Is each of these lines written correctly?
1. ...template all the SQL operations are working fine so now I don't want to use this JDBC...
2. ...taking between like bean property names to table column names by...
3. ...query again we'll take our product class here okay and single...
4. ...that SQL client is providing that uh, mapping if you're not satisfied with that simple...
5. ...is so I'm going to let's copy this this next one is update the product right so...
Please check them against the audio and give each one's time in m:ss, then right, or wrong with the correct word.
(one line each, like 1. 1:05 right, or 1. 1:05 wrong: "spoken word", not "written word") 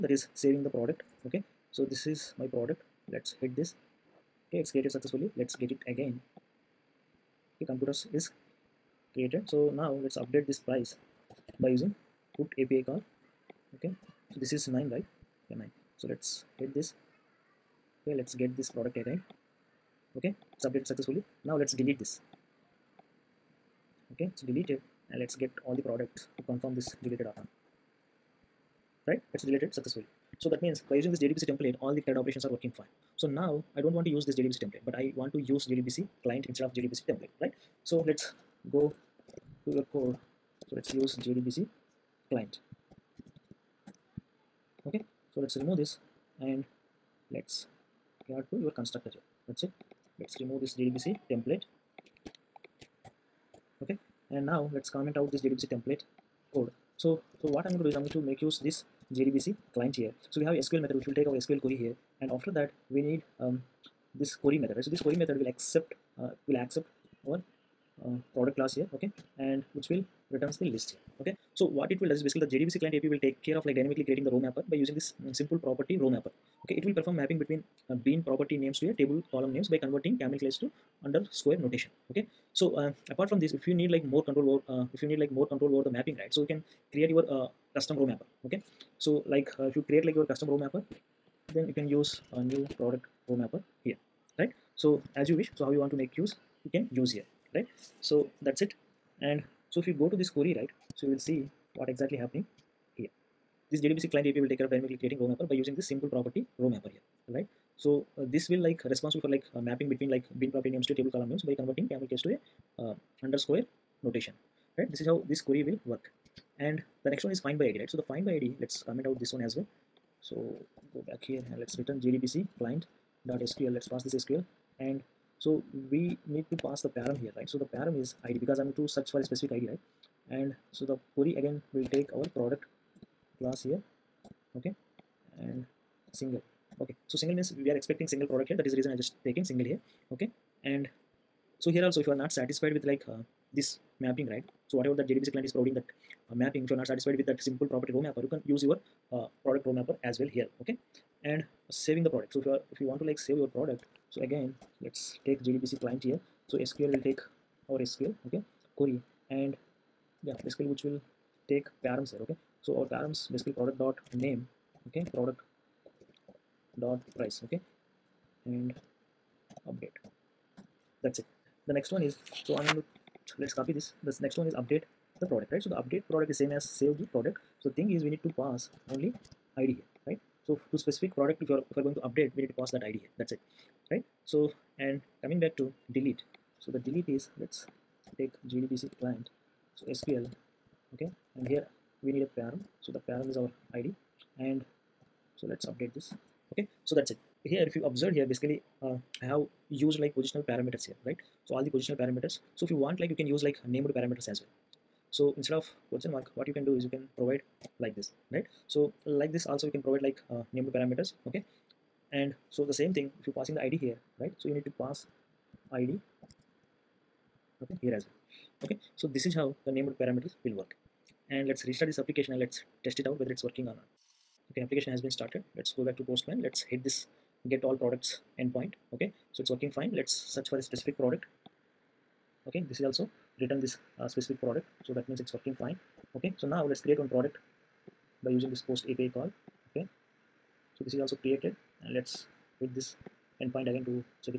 1. 0:31 wrong: "CRUD", not "SQL"
2. 1:49 wrong: "mapping", not "taking"
3. 2:11 right
4. 2:24 wrong: "JDBC", not "SQL"
5. 2:52 right.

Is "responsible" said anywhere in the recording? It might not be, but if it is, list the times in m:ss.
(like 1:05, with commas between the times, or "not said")
1:48.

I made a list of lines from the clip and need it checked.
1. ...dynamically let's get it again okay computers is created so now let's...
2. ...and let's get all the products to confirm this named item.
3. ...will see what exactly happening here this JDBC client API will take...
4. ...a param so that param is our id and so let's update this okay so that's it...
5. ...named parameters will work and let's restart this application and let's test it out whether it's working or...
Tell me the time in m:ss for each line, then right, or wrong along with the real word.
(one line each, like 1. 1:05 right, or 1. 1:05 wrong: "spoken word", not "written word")
1. 0:04 wrong: "successfully", not "dynamically"
2. 0:25 wrong: "deleted", not "named"
3. 1:41 right
4. 3:12 right
5. 3:39 right.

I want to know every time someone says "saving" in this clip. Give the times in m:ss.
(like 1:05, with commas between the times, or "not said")
0:00, 2:31.